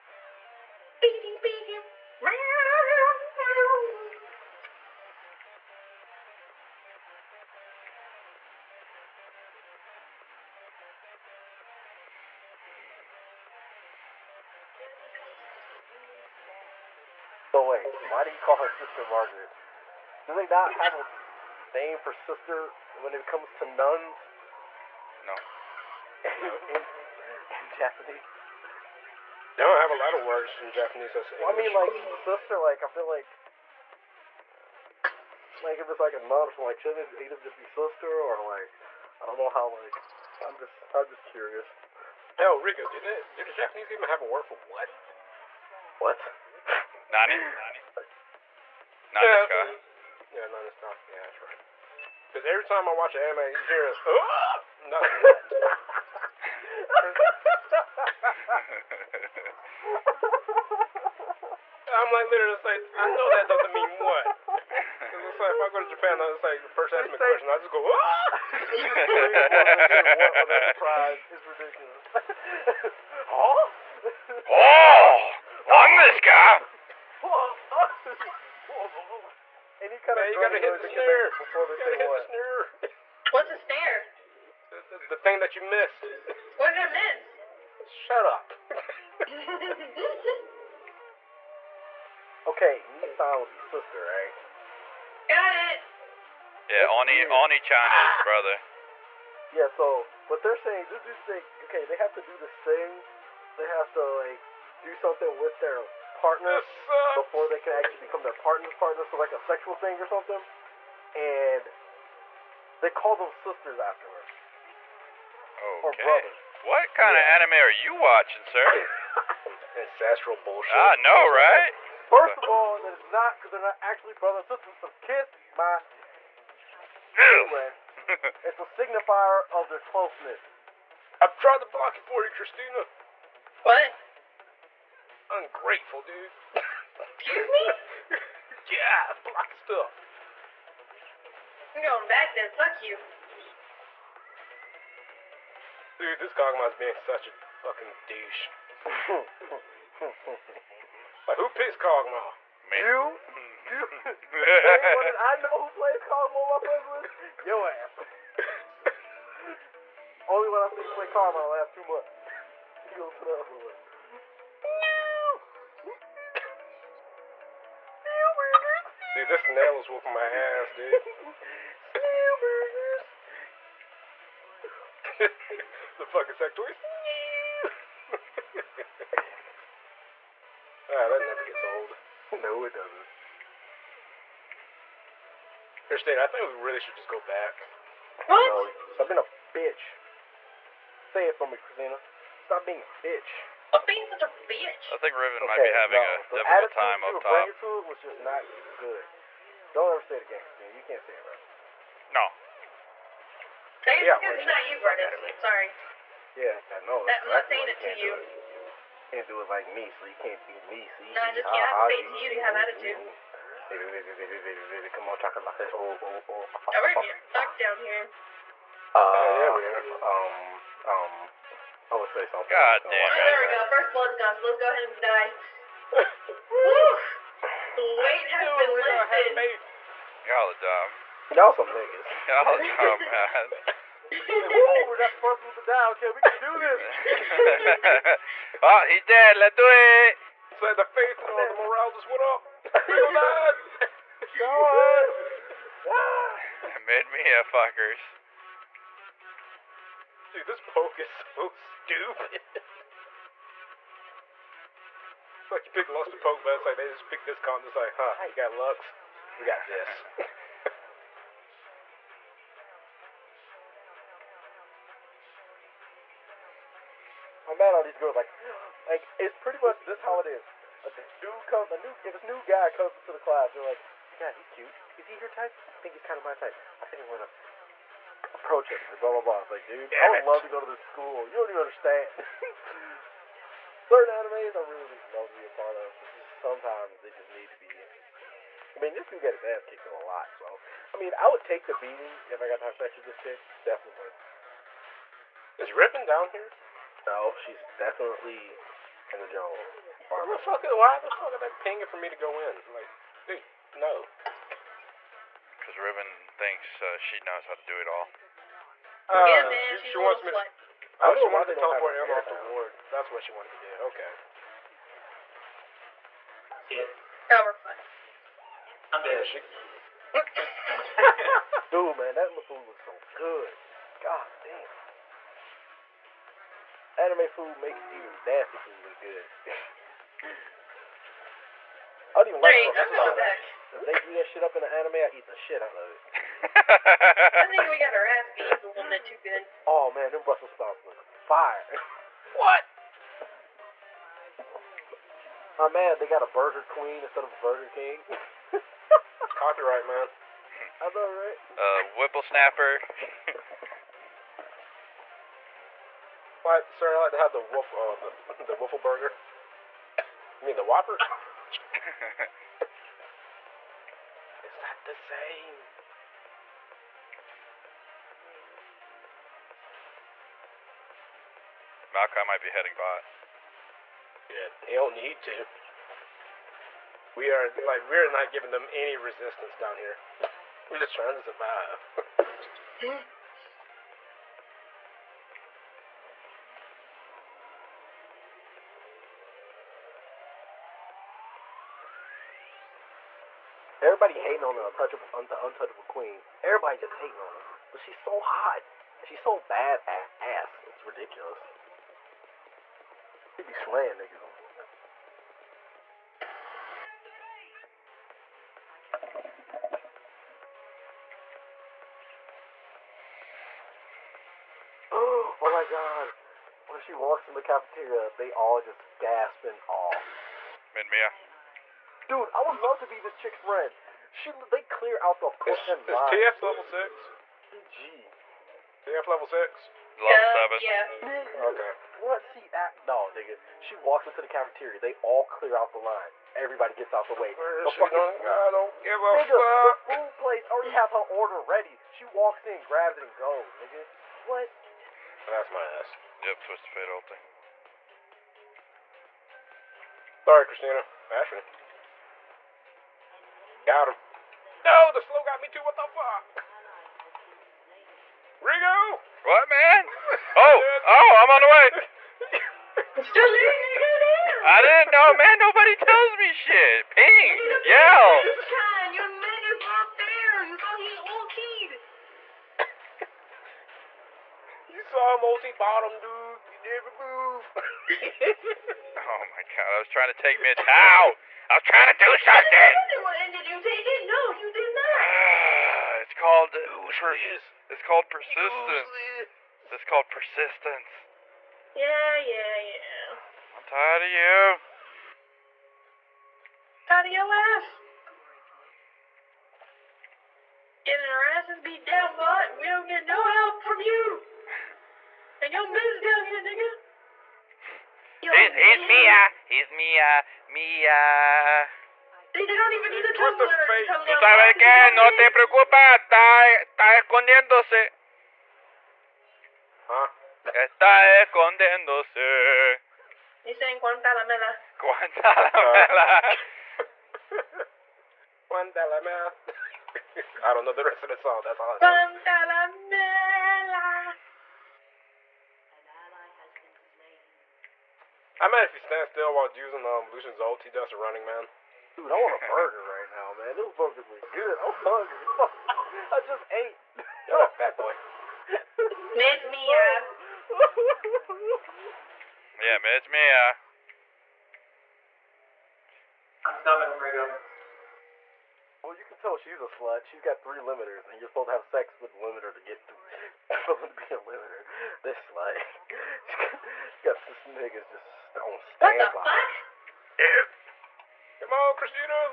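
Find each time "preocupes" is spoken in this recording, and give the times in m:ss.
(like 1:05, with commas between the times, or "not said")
8:35.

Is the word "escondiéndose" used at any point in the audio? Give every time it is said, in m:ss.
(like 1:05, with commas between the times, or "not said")
8:36, 8:41.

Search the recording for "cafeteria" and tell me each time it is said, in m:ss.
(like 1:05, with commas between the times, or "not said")
6:57, 7:14.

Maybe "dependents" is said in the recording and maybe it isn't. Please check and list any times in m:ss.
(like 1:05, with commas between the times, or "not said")
not said.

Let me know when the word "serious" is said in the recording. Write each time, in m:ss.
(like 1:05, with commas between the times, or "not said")
not said.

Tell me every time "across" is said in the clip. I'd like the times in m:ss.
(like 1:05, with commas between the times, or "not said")
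not said.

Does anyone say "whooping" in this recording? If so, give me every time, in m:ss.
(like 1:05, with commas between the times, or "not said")
2:49.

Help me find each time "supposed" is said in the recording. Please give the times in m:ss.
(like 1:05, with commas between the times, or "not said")
3:55, 9:21.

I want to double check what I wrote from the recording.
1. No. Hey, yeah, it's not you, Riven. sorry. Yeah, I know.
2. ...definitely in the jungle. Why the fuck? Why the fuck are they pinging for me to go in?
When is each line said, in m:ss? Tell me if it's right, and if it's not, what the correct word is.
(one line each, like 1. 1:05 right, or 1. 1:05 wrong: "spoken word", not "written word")
1. 3:22 right
2. 4:57 right.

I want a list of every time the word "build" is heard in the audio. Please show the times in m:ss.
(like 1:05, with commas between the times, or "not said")
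not said.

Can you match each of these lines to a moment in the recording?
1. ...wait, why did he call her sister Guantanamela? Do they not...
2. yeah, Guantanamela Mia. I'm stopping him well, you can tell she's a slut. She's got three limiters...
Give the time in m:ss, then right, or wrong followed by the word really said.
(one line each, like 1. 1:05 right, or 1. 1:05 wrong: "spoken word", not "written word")
1. 0:17 wrong: "Margaret", not "Guantanamela"
2. 9:12 wrong: "Mid", not "Guantanamela".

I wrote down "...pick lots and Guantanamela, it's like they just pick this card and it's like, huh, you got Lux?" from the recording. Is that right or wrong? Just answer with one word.
wrong.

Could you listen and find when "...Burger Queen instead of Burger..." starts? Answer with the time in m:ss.
5:46.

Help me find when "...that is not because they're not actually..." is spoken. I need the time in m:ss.
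2:02.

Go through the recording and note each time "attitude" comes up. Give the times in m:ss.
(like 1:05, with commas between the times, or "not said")
3:17, 3:32.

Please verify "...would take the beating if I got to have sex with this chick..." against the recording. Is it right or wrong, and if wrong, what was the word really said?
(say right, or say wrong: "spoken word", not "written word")
right.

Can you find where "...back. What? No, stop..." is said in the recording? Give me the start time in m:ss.
3:07.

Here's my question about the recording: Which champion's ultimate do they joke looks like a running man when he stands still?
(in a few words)
Lucian.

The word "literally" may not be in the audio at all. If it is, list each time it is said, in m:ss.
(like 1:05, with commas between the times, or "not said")
1:02.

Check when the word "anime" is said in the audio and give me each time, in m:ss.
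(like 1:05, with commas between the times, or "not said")
0:53, 1:57, 4:44, 5:26, 5:34.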